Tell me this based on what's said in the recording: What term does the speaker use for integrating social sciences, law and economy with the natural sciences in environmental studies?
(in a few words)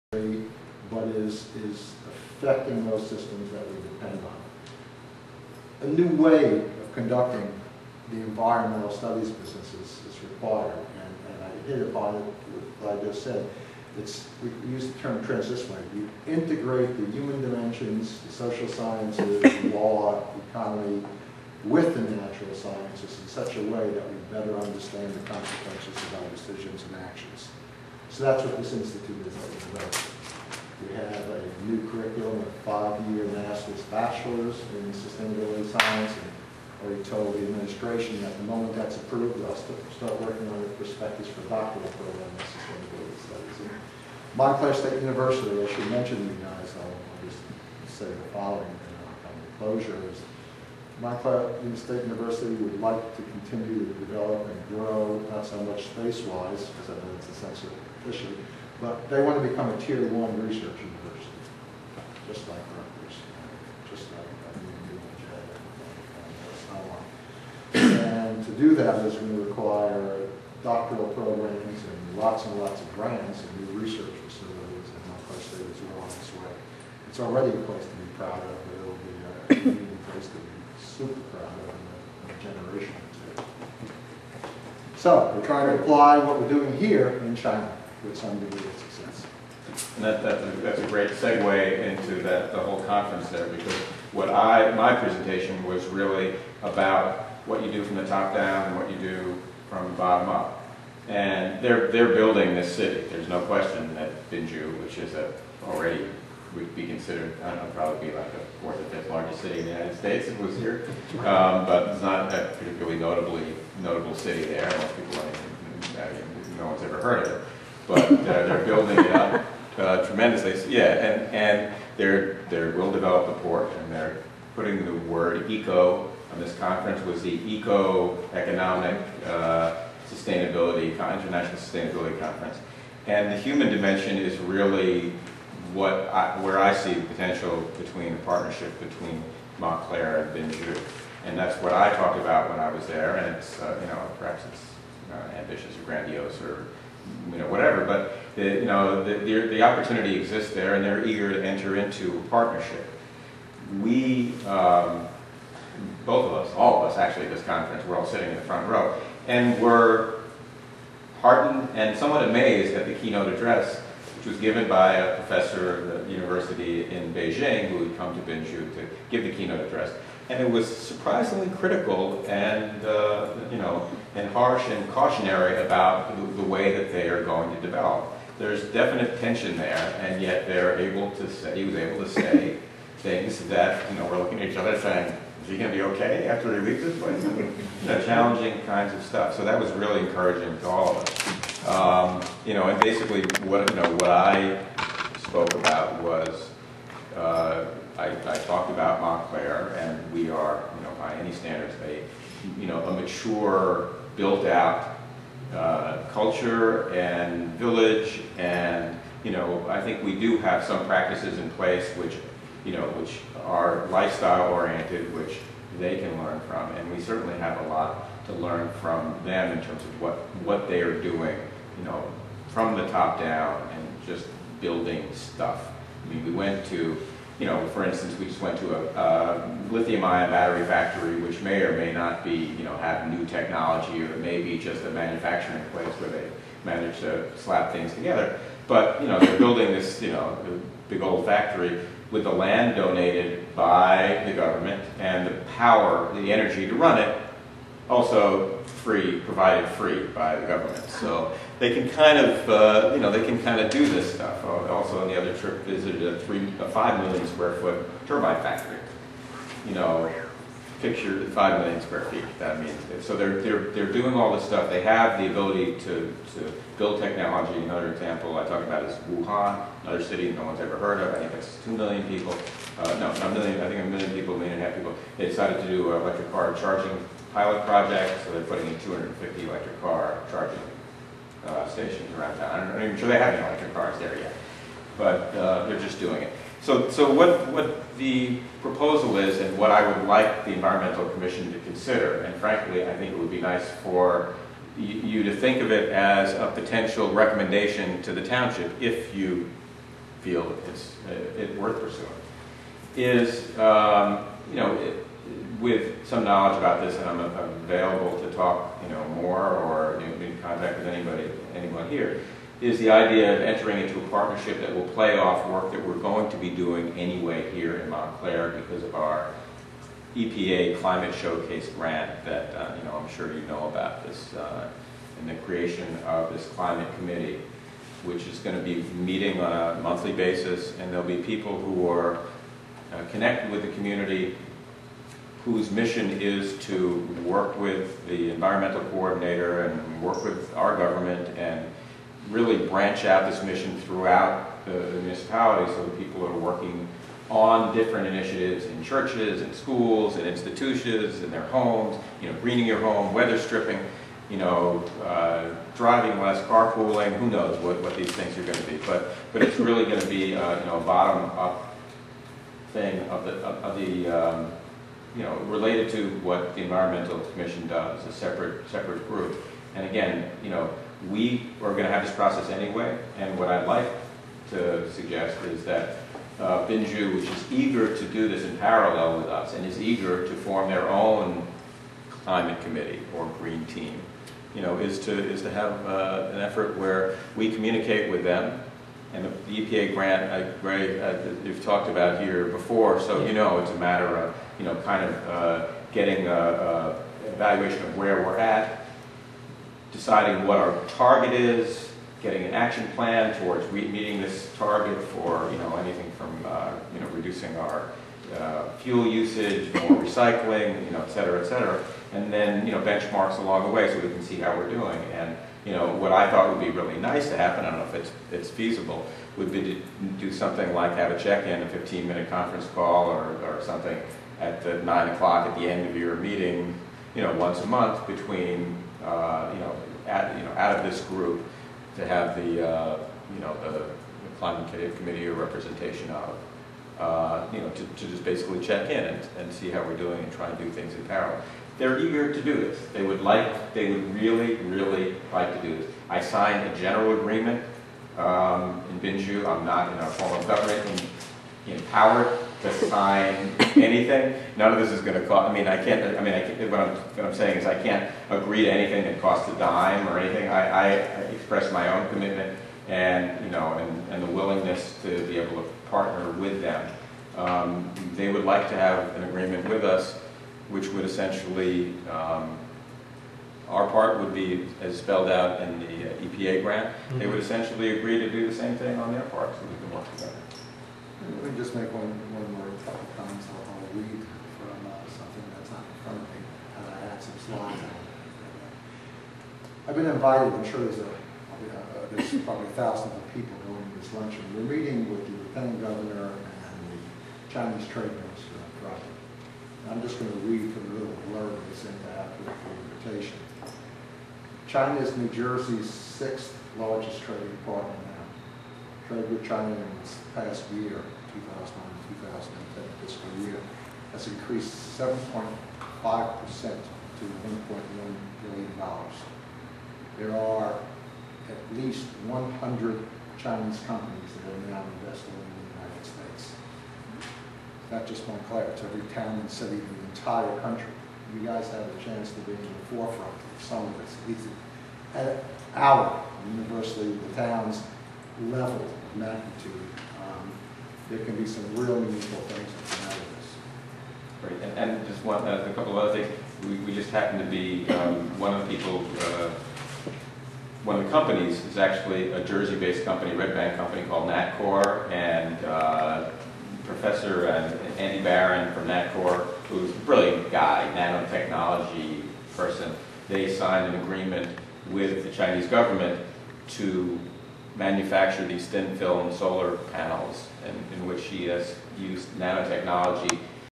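transdisciplinary.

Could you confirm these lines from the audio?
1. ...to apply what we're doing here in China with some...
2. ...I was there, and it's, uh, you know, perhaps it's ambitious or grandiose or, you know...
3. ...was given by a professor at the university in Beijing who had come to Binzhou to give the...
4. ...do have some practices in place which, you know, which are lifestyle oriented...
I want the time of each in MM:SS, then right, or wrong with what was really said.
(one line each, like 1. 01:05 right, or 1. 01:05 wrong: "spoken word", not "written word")
1. 01:25 right
2. 02:22 right
3. 02:44 right
4. 03:30 right.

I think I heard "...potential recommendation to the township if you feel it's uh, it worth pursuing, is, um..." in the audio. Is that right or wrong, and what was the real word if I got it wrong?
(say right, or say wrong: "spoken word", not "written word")
right.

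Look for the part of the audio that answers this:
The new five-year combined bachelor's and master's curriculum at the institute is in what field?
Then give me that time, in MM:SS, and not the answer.
00:34.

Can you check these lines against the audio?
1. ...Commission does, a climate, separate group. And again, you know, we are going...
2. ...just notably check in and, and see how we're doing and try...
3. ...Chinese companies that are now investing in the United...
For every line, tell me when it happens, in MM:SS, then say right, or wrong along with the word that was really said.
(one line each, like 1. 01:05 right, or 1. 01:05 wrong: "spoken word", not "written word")
1. 06:07 wrong: "separate", not "climate"
2. 07:18 wrong: "basically", not "notably"
3. 08:43 right.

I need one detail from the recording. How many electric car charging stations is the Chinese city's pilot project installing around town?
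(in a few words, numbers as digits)
250.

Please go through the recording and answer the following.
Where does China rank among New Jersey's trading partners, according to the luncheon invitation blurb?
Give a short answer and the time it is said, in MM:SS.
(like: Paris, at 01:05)
sixth largest, at 08:25.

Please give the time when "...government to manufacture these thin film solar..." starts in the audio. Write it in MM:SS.
09:25.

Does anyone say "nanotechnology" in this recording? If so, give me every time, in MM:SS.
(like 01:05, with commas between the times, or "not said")
09:20, 09:32.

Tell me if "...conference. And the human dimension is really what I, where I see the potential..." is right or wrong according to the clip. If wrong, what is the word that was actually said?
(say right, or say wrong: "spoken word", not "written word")
right.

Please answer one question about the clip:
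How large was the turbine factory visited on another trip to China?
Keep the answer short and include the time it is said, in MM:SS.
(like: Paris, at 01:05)
5,000,000 square feet, at 04:16.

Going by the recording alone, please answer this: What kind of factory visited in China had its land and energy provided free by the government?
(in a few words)
lithium-ion battery factory.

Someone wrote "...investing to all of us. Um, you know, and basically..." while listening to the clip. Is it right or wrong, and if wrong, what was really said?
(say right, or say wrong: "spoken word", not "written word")
wrong: "encouraging", not "investing".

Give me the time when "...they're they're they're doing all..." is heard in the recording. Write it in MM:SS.
04:23.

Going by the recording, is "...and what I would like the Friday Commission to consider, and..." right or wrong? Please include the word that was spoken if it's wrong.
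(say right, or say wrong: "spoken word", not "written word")
wrong: "Environmental", not "Friday".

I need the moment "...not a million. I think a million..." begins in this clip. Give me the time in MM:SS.
04:33.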